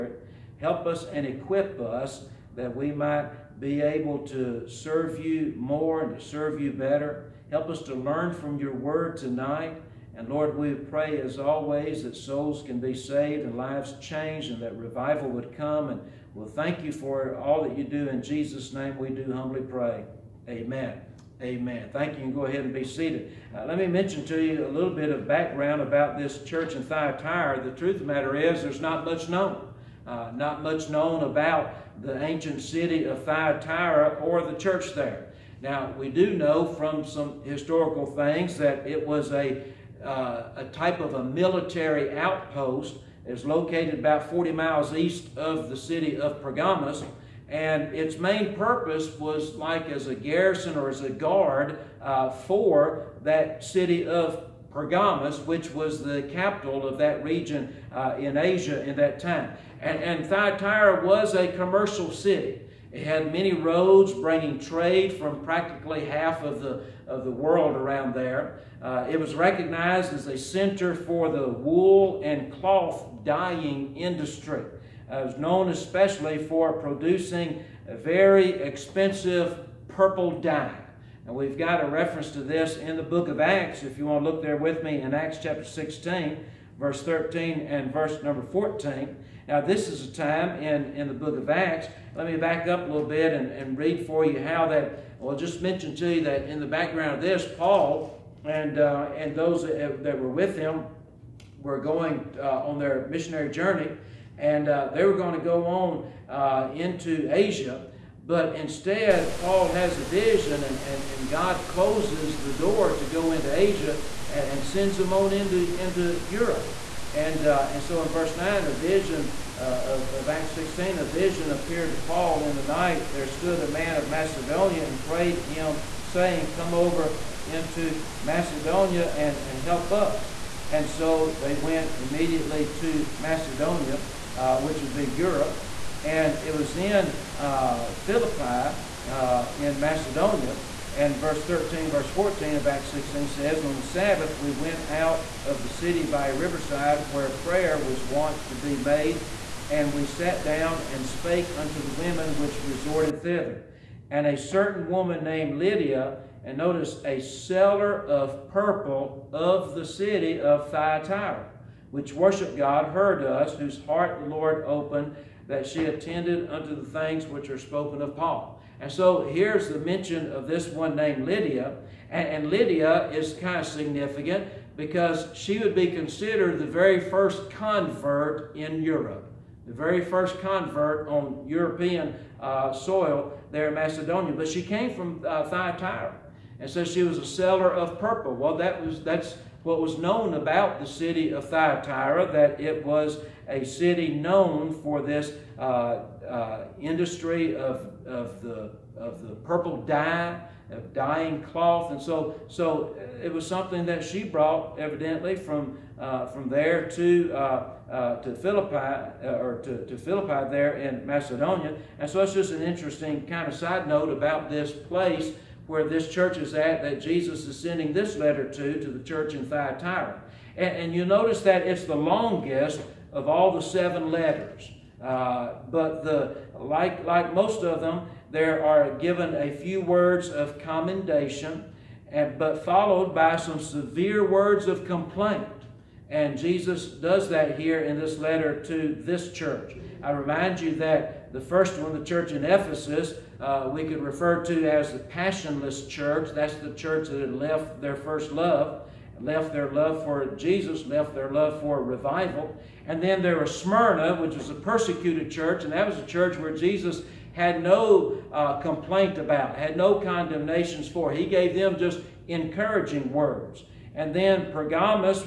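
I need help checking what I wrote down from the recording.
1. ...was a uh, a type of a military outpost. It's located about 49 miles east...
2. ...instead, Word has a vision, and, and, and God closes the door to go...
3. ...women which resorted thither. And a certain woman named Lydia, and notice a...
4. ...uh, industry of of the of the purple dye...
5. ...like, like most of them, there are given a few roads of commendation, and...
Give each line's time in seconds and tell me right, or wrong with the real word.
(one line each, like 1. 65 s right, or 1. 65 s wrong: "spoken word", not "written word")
1. 39 s wrong: "40", not "49"
2. 108 s wrong: "Paul", not "Word"
3. 151 s right
4. 196 s right
5. 226 s wrong: "words", not "roads".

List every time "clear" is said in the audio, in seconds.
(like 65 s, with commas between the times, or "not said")
not said.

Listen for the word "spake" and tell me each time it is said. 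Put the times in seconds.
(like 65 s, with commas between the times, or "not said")
151 s.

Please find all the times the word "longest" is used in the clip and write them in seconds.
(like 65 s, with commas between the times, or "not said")
221 s.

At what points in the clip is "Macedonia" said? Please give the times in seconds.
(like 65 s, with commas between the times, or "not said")
124 s, 128 s, 133 s, 139 s, 183 s, 211 s.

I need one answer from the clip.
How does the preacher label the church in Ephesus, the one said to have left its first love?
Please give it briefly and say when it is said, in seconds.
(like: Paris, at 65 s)
the passionless church, at 244 s.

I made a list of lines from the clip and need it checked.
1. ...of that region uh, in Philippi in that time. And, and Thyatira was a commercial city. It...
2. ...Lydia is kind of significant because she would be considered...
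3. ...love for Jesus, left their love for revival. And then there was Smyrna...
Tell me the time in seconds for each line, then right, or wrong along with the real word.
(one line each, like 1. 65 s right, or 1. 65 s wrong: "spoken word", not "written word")
1. 56 s wrong: "Asia", not "Philippi"
2. 172 s right
3. 249 s right.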